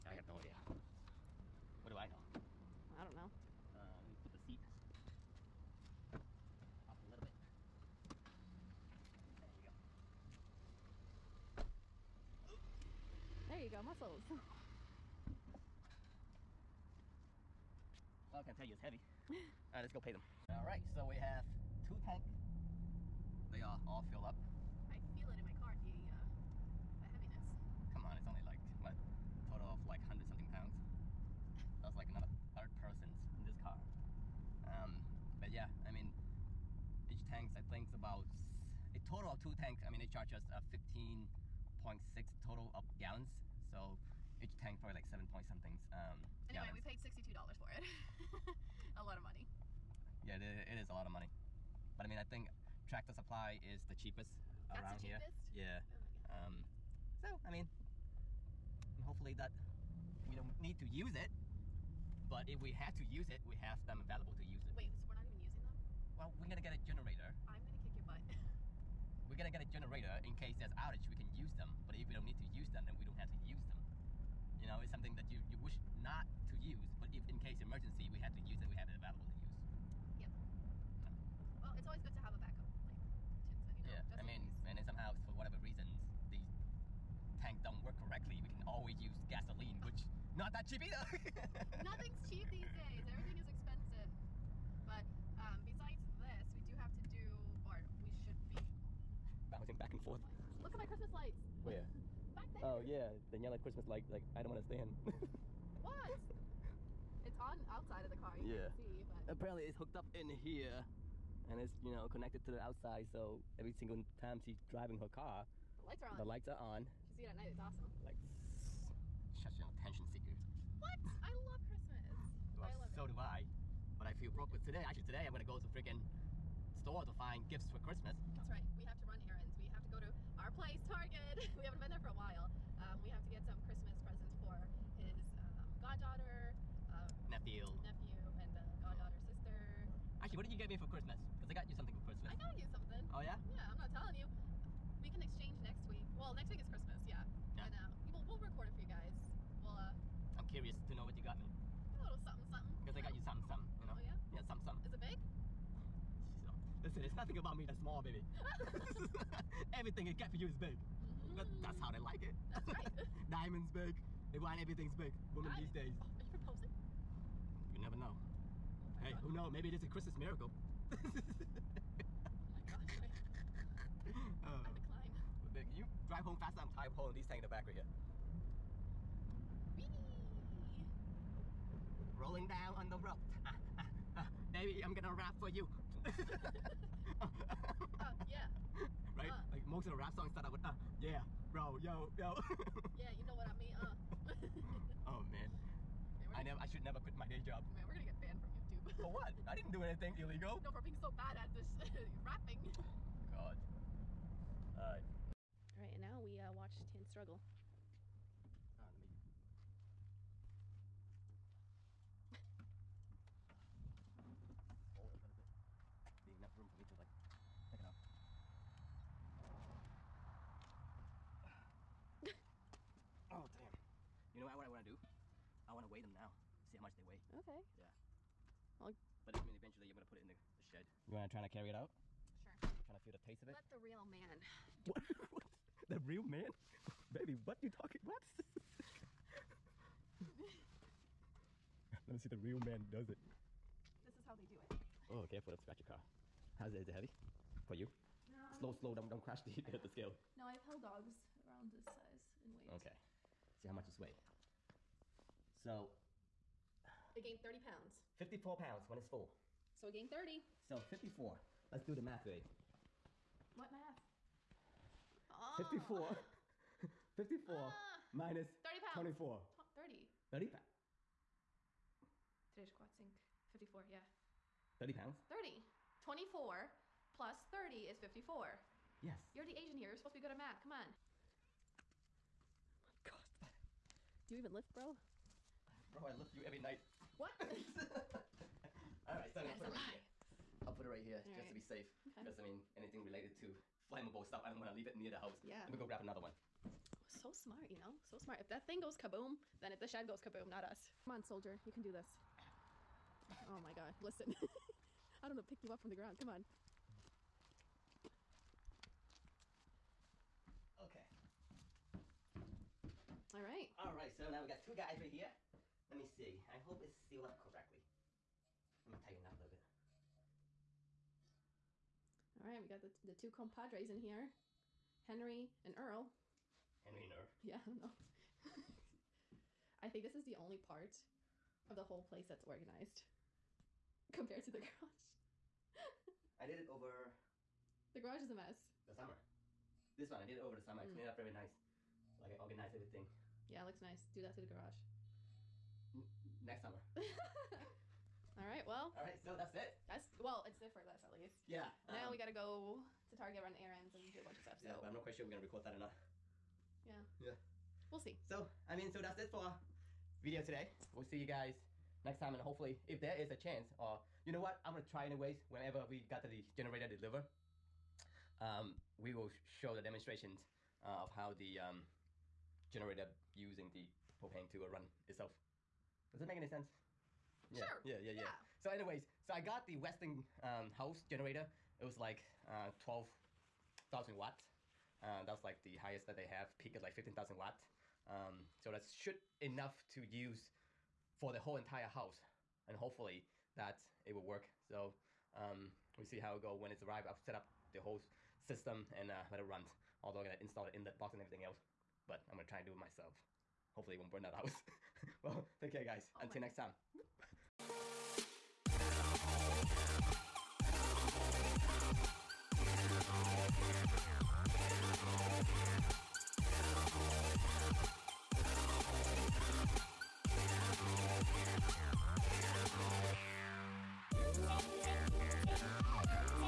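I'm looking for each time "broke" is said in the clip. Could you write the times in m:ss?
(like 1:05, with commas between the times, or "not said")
2:04.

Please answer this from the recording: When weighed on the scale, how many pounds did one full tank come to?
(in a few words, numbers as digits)
54.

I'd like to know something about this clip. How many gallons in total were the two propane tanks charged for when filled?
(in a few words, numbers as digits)
15.6.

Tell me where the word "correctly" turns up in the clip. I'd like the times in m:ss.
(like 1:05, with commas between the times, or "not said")
1:27, 5:17.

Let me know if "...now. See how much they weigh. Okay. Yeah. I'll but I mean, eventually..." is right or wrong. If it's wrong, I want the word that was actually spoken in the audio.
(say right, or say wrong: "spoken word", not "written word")
right.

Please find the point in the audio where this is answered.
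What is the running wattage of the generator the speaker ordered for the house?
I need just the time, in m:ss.
6:22.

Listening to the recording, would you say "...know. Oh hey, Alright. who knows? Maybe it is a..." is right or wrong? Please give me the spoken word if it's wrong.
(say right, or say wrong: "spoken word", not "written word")
wrong: "God", not "Alright".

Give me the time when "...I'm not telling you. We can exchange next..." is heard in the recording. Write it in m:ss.
2:23.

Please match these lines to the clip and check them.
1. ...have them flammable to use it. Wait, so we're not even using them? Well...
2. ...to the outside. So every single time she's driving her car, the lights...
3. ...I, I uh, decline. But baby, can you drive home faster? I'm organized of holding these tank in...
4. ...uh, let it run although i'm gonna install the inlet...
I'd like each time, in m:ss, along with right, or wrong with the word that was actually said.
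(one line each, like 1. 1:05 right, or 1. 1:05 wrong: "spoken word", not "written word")
1. 1:03 wrong: "available", not "flammable"
2. 1:52 right
3. 2:52 wrong: "tired", not "organized"
4. 6:39 right.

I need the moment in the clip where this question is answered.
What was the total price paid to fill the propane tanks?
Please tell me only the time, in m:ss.
0:46.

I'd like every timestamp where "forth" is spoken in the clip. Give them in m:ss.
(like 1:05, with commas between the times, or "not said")
1:40.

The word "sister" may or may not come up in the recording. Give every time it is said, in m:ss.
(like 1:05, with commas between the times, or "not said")
2:19.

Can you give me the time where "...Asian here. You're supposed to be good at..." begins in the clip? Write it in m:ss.
4:39.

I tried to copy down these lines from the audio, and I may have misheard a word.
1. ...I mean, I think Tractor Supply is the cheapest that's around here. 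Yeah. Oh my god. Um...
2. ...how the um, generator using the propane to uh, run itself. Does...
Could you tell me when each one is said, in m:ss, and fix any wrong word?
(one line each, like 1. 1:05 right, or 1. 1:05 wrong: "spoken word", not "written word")
1. 0:52 right
2. 6:11 right.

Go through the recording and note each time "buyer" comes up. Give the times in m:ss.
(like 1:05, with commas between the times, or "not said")
not said.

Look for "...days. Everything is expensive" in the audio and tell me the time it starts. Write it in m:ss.
1:32.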